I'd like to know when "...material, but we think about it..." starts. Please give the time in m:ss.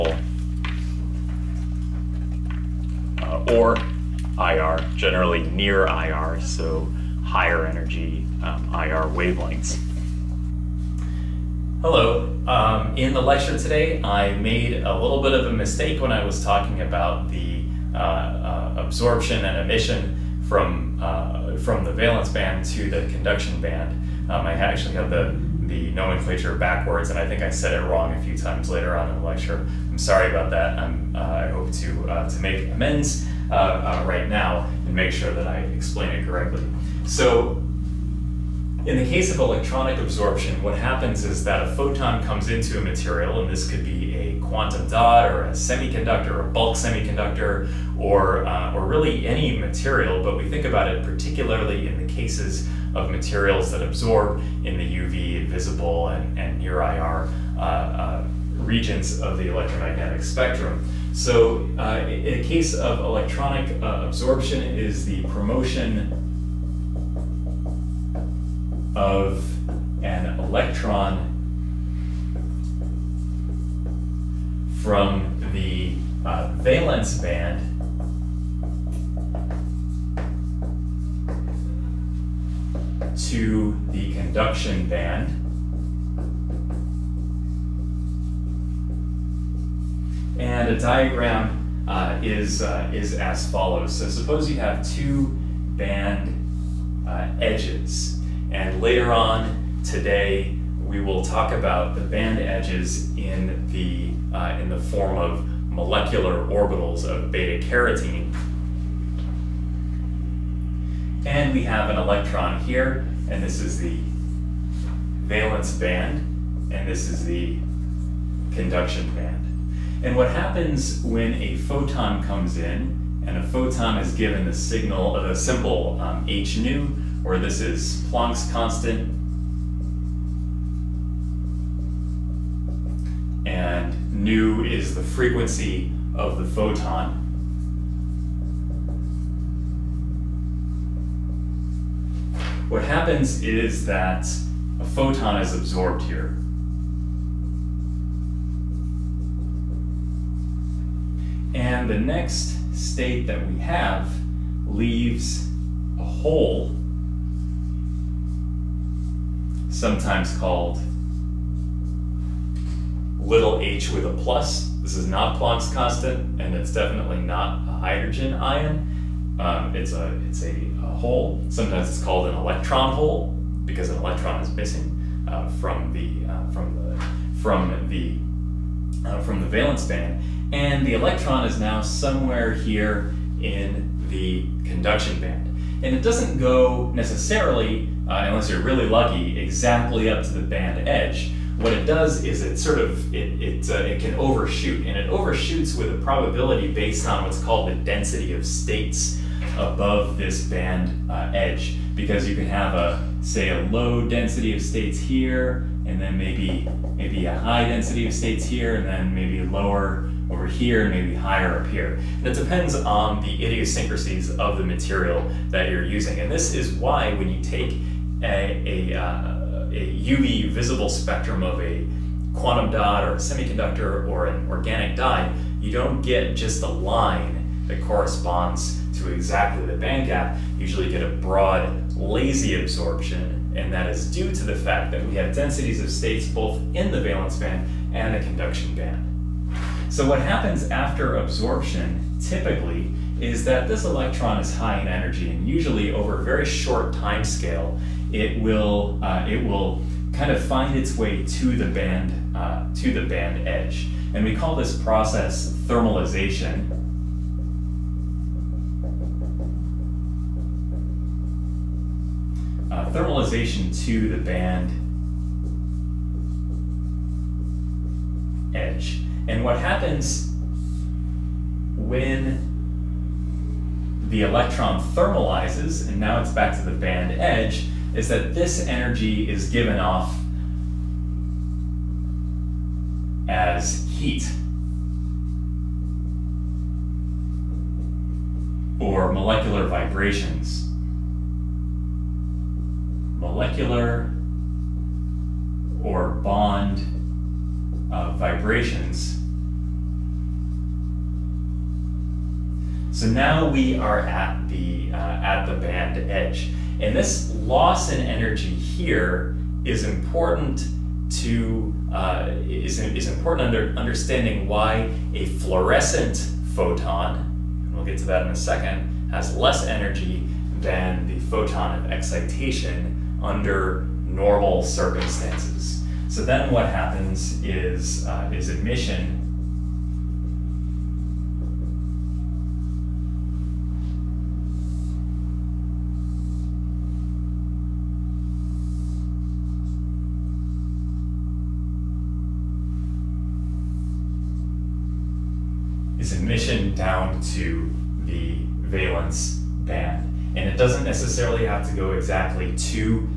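0:49.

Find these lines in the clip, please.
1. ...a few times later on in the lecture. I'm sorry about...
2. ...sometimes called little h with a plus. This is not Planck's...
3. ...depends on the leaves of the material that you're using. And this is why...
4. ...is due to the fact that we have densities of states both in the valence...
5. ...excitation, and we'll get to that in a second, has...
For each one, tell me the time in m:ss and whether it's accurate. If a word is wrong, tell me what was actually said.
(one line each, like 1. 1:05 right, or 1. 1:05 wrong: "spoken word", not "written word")
1. 0:28 right
2. 2:39 right
3. 3:32 wrong: "idiosyncrasies", not "leaves"
4. 3:53 right
5. 5:16 wrong: "photon", not "excitation".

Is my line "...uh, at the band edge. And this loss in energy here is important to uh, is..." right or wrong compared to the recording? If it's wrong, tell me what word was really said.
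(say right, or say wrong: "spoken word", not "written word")
right.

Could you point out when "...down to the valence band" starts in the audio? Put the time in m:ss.
5:46.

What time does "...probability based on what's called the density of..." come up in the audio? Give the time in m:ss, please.
3:15.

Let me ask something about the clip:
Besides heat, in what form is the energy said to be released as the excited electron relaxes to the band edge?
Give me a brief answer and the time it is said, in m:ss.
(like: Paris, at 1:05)
molecular vibrations, at 4:49.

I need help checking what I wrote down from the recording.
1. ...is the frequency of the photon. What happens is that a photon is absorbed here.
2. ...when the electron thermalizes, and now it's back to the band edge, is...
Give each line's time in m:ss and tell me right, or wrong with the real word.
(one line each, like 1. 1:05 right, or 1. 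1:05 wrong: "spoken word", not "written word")
1. 2:14 right
2. 4:31 right.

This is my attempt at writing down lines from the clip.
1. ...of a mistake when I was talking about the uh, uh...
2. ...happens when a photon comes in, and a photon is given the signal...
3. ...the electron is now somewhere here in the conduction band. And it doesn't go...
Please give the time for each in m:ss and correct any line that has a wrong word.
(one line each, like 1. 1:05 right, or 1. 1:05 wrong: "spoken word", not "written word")
1. 0:15 right
2. 2:00 right
3. 3:00 right.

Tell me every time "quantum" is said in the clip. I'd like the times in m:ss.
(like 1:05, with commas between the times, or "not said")
0:44, 3:42.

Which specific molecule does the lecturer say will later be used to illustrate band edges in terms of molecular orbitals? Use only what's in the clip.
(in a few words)
beta carotene.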